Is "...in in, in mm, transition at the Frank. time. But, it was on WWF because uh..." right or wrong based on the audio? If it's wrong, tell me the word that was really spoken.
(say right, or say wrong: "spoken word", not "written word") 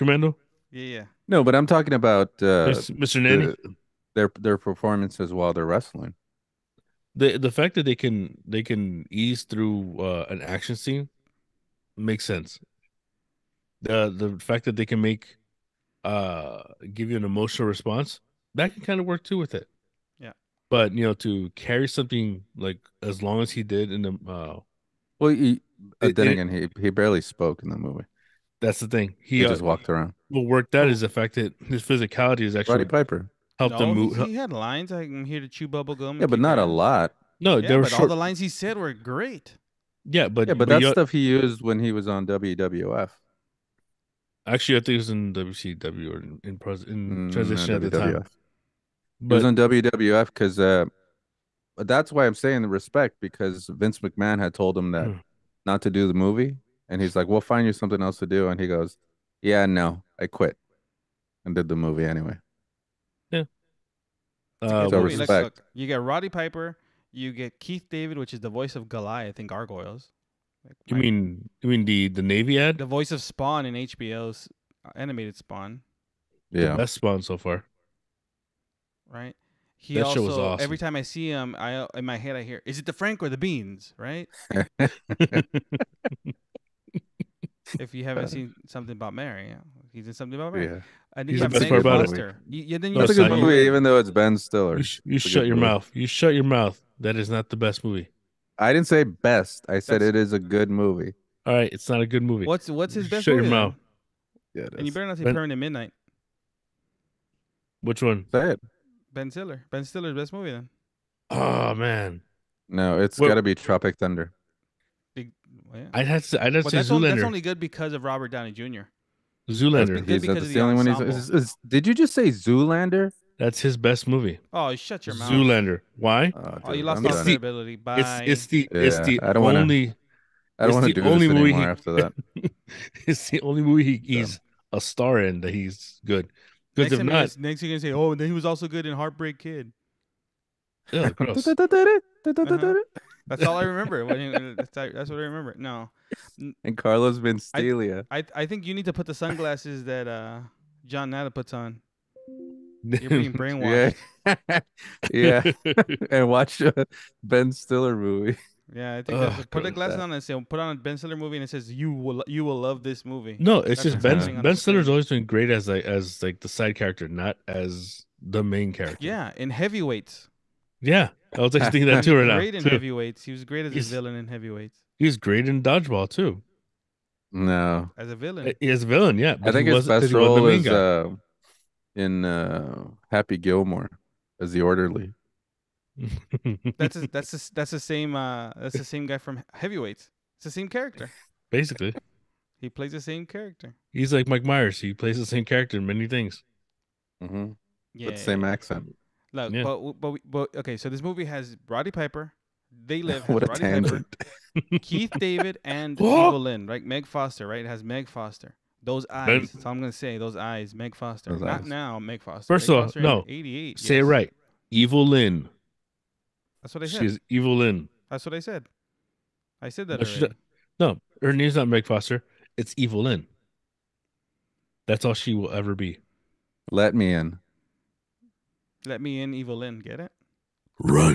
wrong: "WWF", not "Frank".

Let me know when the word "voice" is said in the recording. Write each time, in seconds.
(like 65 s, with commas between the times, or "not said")
68 s, 72 s.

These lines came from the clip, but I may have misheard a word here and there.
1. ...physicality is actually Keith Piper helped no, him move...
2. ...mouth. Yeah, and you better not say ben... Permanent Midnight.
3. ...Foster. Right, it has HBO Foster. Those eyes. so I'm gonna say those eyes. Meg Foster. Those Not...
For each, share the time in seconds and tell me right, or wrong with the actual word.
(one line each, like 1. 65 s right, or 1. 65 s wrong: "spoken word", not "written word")
1. 31 s wrong: "Roddy", not "Keith"
2. 103 s right
3. 207 s wrong: "Meg", not "HBO".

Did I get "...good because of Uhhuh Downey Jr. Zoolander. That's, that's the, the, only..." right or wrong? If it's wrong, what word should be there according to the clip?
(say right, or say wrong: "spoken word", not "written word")
wrong: "Robert", not "Uhhuh".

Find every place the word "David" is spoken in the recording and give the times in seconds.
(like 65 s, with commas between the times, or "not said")
67 s, 205 s.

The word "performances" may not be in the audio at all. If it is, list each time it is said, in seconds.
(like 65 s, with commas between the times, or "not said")
4 s.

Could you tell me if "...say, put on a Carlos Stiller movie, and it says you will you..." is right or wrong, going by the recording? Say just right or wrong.
wrong.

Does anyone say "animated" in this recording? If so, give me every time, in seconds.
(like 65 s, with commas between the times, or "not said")
74 s.